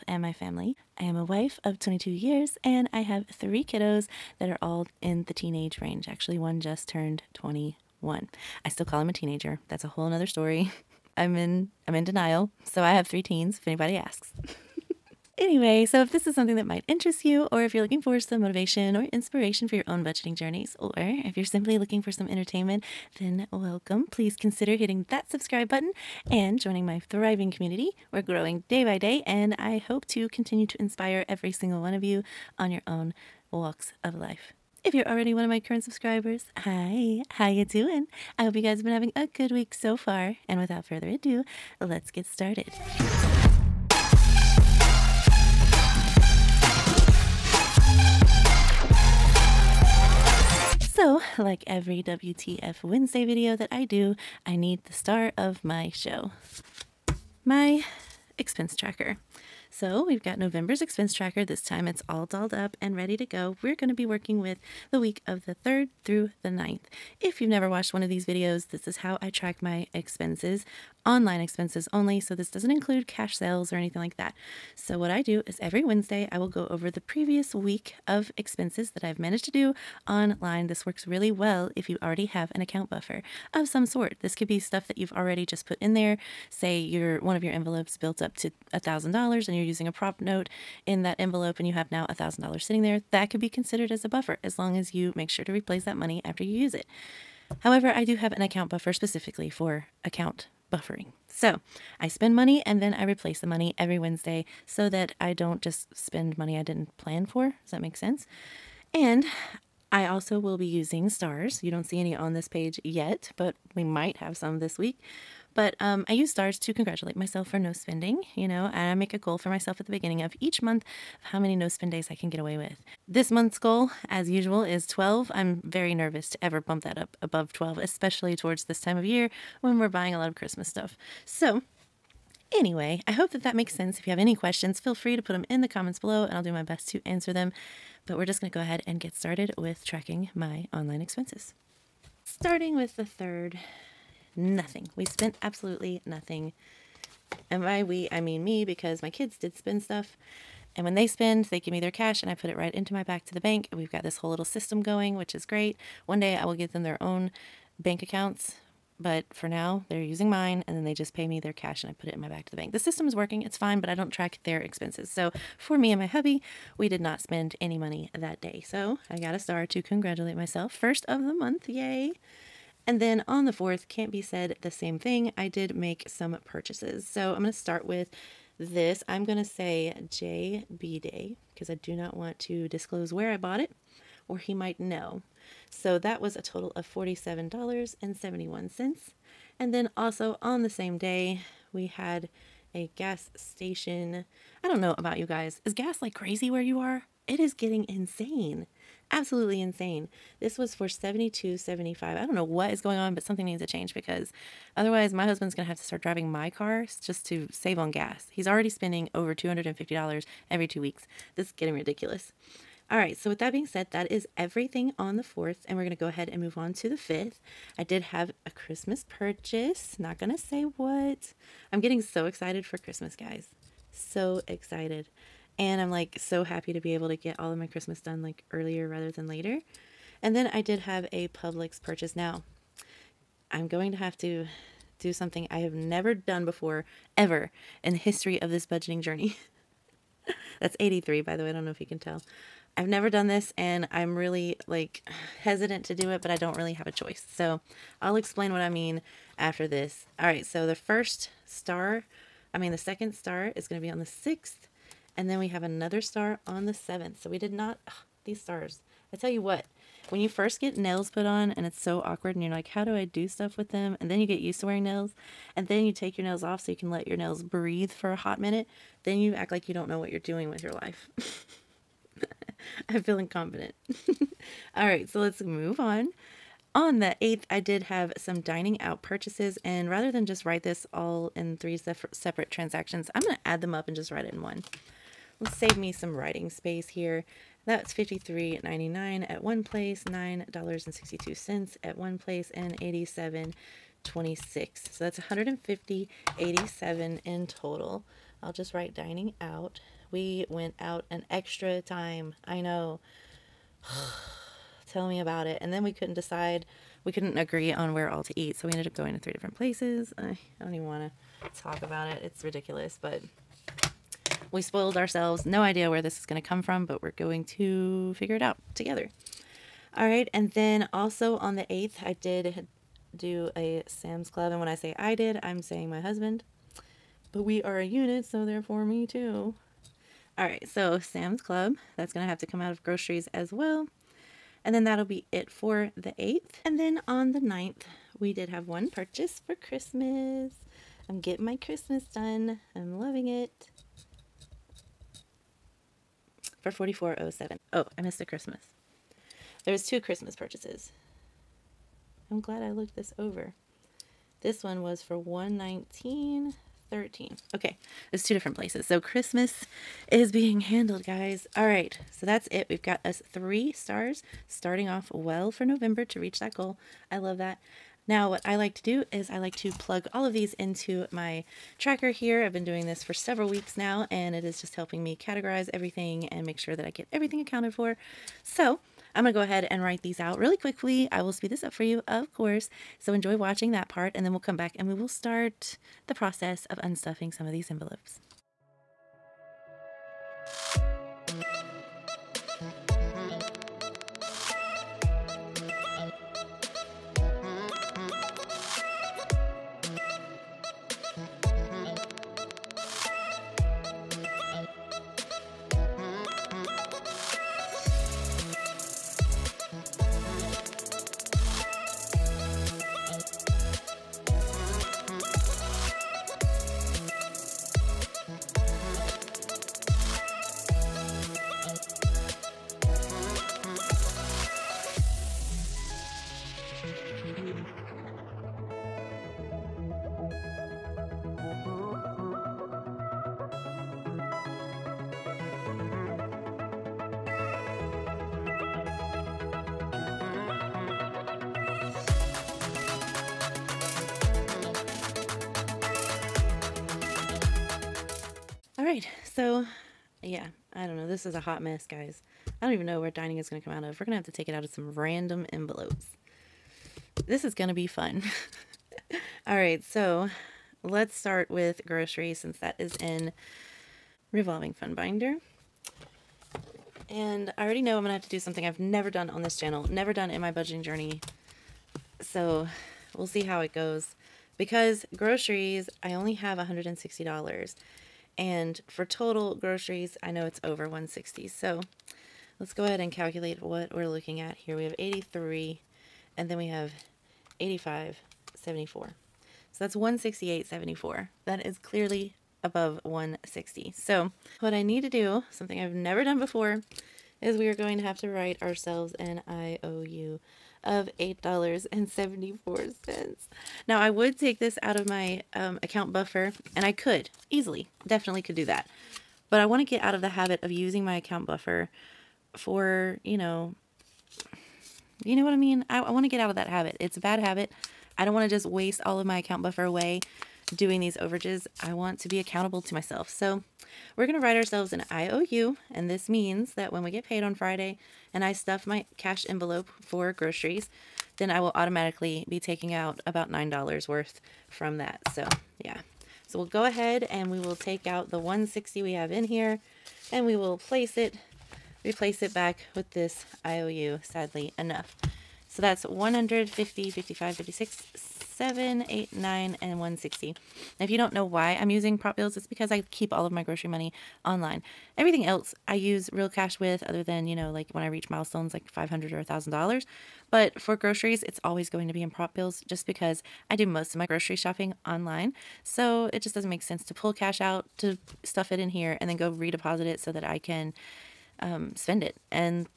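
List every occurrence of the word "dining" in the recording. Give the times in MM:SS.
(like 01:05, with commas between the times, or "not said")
04:38, 04:58, 07:33.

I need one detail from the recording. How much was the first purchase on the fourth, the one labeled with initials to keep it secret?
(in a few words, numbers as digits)
$47.71.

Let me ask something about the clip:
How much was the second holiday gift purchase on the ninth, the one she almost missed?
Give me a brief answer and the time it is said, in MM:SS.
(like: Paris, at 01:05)
$119.13, at 05:55.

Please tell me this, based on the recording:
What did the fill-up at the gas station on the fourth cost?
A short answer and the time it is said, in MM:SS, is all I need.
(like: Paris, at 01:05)
$72.75, at 03:20.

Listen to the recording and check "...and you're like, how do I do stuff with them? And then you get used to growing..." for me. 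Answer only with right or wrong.
wrong.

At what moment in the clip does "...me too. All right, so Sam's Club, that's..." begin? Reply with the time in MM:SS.
05:28.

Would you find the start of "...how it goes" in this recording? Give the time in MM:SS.
07:53.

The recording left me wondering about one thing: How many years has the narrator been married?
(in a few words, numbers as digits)
22.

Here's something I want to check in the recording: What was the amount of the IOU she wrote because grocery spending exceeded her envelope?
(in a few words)
$8.74.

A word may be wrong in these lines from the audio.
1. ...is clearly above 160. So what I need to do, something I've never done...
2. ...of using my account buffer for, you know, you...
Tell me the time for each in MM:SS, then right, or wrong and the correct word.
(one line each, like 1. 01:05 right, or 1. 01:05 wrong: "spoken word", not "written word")
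1. 08:11 right
2. 08:30 right.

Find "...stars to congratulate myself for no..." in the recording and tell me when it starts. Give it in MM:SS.
01:56.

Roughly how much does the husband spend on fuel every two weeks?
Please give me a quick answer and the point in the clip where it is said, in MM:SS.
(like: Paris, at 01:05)
over $250, at 03:29.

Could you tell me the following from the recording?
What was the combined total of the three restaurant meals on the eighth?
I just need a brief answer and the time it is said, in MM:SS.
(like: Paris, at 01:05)
$150.87, at 04:55.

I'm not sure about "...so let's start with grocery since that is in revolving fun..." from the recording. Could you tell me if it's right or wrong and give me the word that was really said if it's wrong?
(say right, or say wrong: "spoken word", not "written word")
right.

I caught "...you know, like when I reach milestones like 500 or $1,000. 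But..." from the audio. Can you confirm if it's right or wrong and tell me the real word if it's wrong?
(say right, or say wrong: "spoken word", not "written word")
right.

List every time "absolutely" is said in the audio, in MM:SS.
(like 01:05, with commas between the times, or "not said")
02:25, 03:19.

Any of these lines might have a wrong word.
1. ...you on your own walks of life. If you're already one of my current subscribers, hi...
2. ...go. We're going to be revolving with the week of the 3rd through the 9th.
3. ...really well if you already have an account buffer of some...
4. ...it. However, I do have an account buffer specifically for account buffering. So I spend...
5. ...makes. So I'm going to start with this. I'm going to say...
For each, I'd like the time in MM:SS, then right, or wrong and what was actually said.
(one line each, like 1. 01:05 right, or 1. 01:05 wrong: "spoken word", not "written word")
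1. 00:32 right
2. 01:03 wrong: "working", not "revolving"
3. 01:21 right
4. 01:36 right
5. 02:56 wrong: "purchases", not "makes".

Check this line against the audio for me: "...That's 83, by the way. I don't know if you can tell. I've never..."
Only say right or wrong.
right.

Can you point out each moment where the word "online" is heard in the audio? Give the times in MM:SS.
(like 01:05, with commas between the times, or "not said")
01:11, 01:20, 02:20, 09:14, 09:25.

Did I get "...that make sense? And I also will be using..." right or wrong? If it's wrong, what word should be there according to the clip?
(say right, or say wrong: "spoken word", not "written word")
right.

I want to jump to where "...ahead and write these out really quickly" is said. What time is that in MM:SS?
06:19.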